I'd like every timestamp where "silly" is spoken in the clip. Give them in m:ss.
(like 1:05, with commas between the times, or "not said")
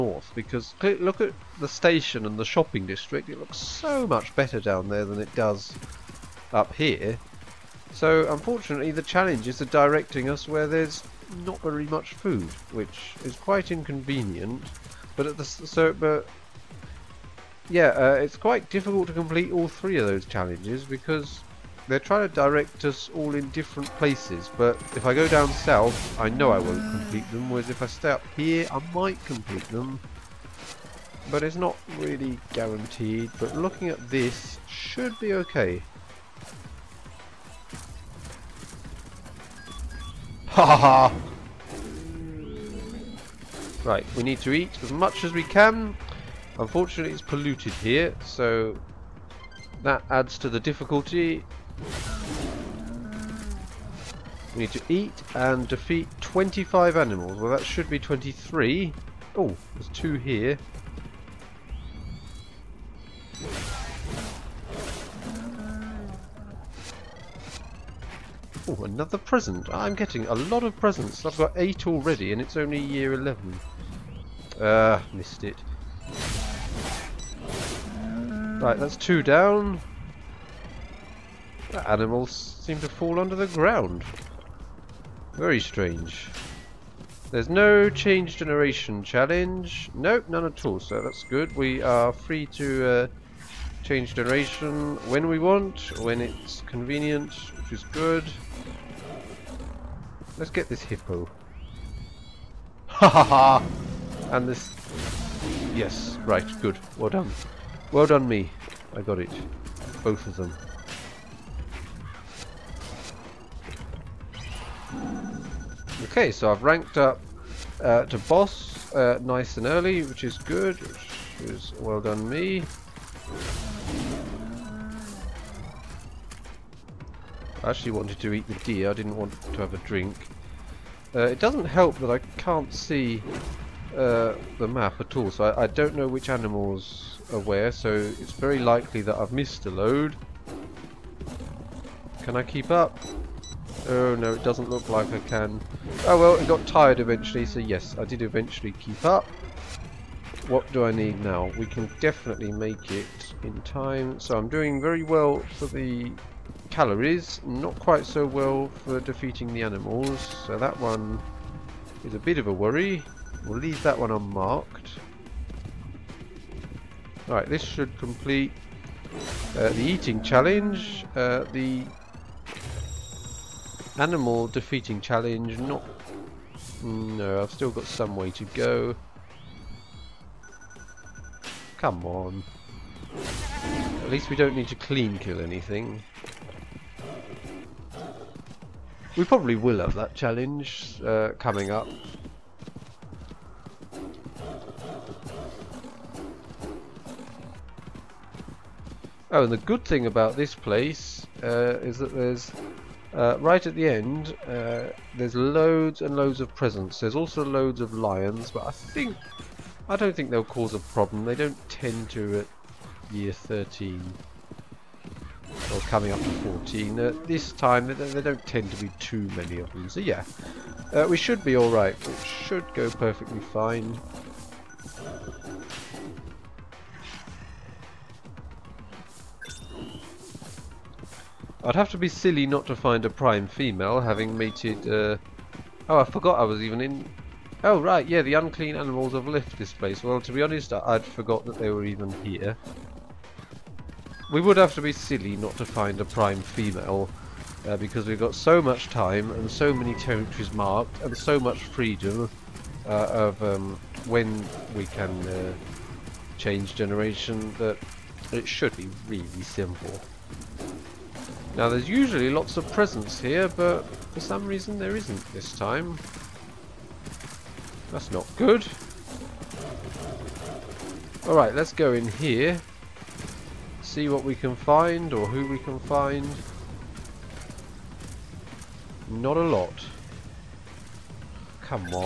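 3:52, 4:04.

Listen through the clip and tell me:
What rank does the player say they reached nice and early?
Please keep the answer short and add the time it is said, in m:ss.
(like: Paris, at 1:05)
boss, at 1:58.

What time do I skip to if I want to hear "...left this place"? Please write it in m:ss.
3:59.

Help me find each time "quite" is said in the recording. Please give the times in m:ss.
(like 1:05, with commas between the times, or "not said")
0:13, 0:18, 2:37.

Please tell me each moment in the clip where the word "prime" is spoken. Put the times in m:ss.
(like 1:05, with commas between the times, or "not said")
3:53, 4:06.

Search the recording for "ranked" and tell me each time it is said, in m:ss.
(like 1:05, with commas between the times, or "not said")
1:56.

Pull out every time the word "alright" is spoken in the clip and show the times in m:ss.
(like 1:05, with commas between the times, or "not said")
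3:41, 4:31.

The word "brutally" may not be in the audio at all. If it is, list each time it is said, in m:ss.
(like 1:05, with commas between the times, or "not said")
not said.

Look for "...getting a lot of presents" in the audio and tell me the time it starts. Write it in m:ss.
1:09.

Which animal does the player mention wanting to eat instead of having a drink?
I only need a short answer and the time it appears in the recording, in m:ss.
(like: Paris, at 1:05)
deer, at 2:08.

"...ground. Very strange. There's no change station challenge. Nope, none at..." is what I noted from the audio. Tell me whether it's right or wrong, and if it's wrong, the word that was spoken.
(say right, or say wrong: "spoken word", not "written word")
wrong: "generation", not "station".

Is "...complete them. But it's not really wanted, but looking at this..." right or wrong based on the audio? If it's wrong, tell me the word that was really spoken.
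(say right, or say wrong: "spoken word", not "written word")
wrong: "guaranteed", not "wanted".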